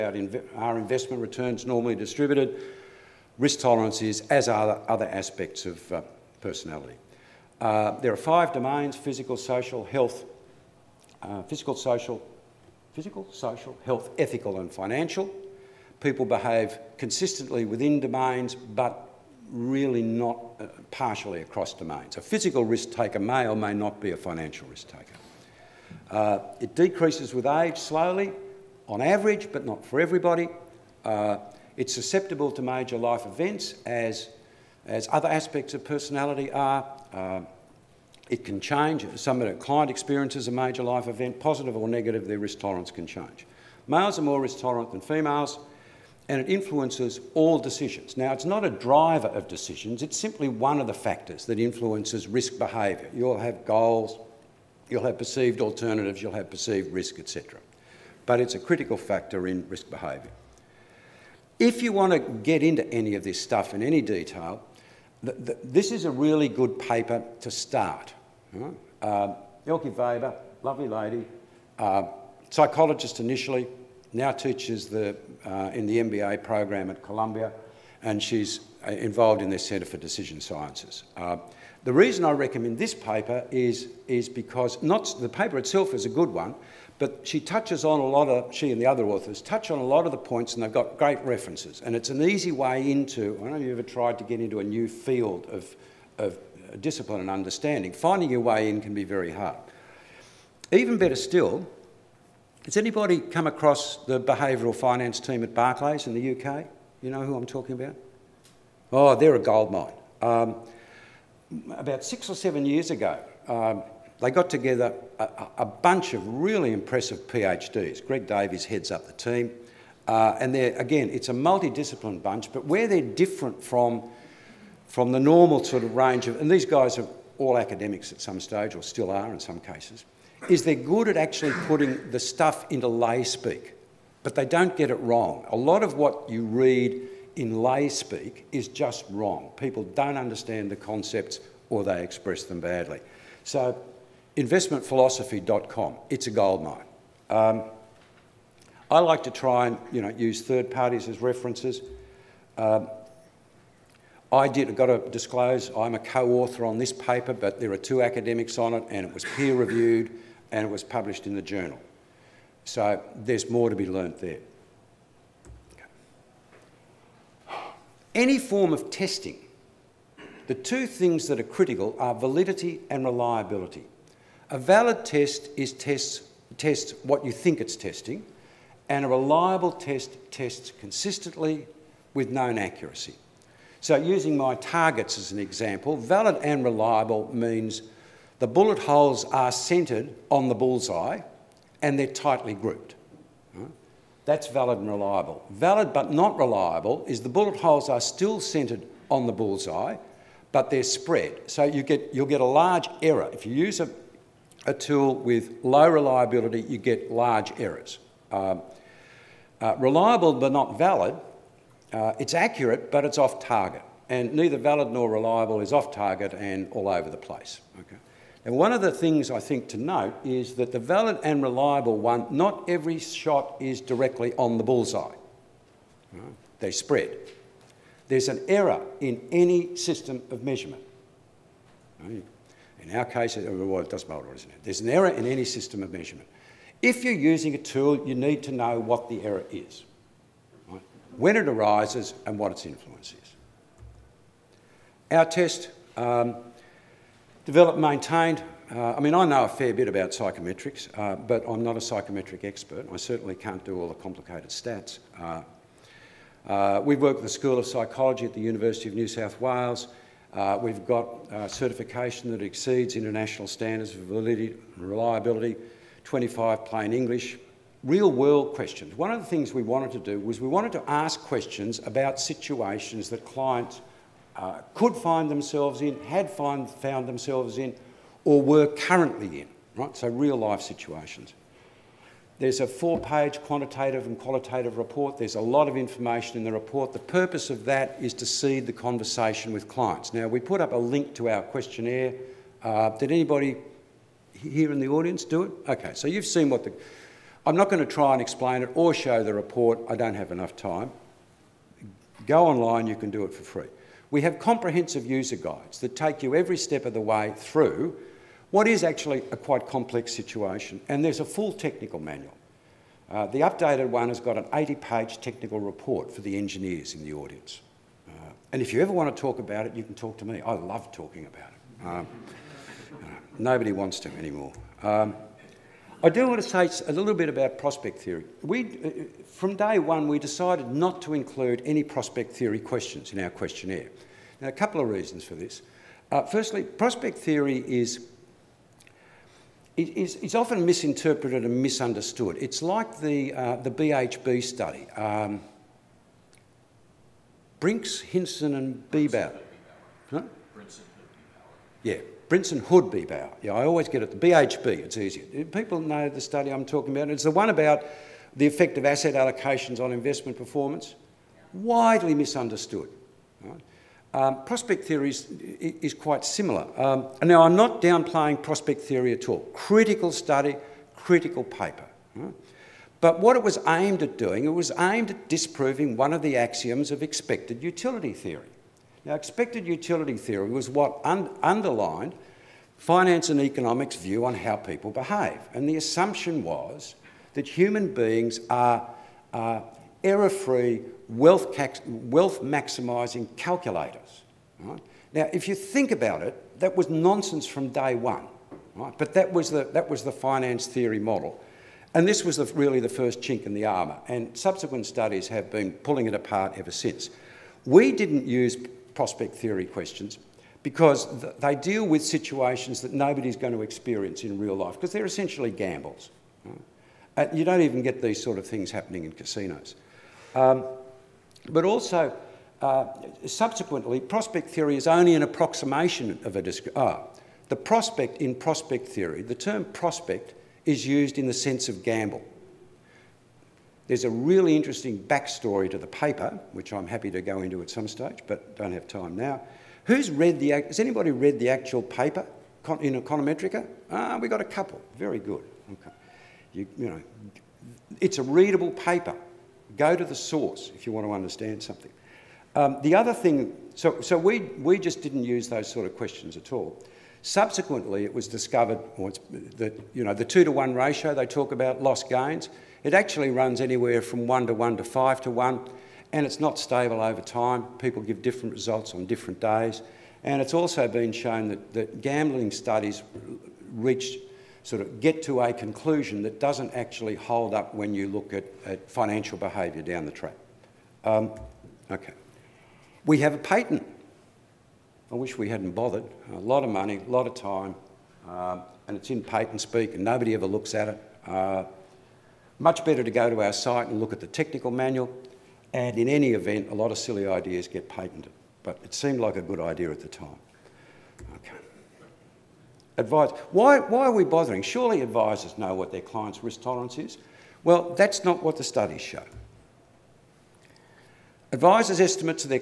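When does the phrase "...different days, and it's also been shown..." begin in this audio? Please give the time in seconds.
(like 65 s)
469 s.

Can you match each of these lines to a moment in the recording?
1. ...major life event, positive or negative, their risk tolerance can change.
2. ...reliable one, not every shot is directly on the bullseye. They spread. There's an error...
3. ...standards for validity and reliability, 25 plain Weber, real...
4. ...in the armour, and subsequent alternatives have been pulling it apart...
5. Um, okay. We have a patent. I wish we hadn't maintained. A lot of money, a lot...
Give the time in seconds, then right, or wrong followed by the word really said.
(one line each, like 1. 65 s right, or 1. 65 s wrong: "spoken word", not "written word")
1. 40 s right
2. 221 s right
3. 263 s wrong: "English", not "Weber"
4. 403 s wrong: "studies", not "alternatives"
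5. 481 s wrong: "bothered", not "maintained".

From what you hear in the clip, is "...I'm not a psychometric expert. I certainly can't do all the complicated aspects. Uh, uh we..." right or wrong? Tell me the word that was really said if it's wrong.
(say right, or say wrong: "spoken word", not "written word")
wrong: "stats", not "aspects".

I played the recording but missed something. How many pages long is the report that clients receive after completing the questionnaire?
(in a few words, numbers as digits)
4.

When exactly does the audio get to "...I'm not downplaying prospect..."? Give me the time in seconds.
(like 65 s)
367 s.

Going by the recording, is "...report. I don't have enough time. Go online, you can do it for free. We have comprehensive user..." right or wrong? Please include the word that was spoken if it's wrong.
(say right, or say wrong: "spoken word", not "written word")
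right.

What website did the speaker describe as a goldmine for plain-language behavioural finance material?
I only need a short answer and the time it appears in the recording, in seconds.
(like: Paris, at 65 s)
investmentphilosophy.com, at 144 s.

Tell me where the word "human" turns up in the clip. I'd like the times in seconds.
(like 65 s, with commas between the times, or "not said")
387 s.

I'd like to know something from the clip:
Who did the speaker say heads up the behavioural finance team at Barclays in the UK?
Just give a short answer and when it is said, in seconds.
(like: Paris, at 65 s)
Greg Davies, at 118 s.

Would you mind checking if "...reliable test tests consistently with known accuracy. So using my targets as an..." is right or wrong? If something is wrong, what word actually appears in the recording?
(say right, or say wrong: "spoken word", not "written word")
right.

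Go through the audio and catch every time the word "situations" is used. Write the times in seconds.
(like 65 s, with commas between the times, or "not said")
272 s, 280 s, 310 s, 412 s.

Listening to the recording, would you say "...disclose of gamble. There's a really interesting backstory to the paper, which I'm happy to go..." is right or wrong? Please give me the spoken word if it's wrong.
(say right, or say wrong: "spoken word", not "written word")
wrong: "sense", not "disclose".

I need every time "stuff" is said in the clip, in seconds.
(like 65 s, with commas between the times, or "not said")
63 s, 132 s.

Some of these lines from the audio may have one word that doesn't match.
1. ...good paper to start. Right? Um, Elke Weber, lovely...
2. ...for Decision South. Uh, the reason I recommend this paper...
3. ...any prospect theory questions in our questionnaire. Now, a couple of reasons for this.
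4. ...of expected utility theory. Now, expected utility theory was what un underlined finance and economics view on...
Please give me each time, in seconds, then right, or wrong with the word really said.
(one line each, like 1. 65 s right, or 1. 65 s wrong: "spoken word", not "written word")
1. 66 s right
2. 79 s wrong: "Sciences", not "South"
3. 331 s right
4. 376 s right.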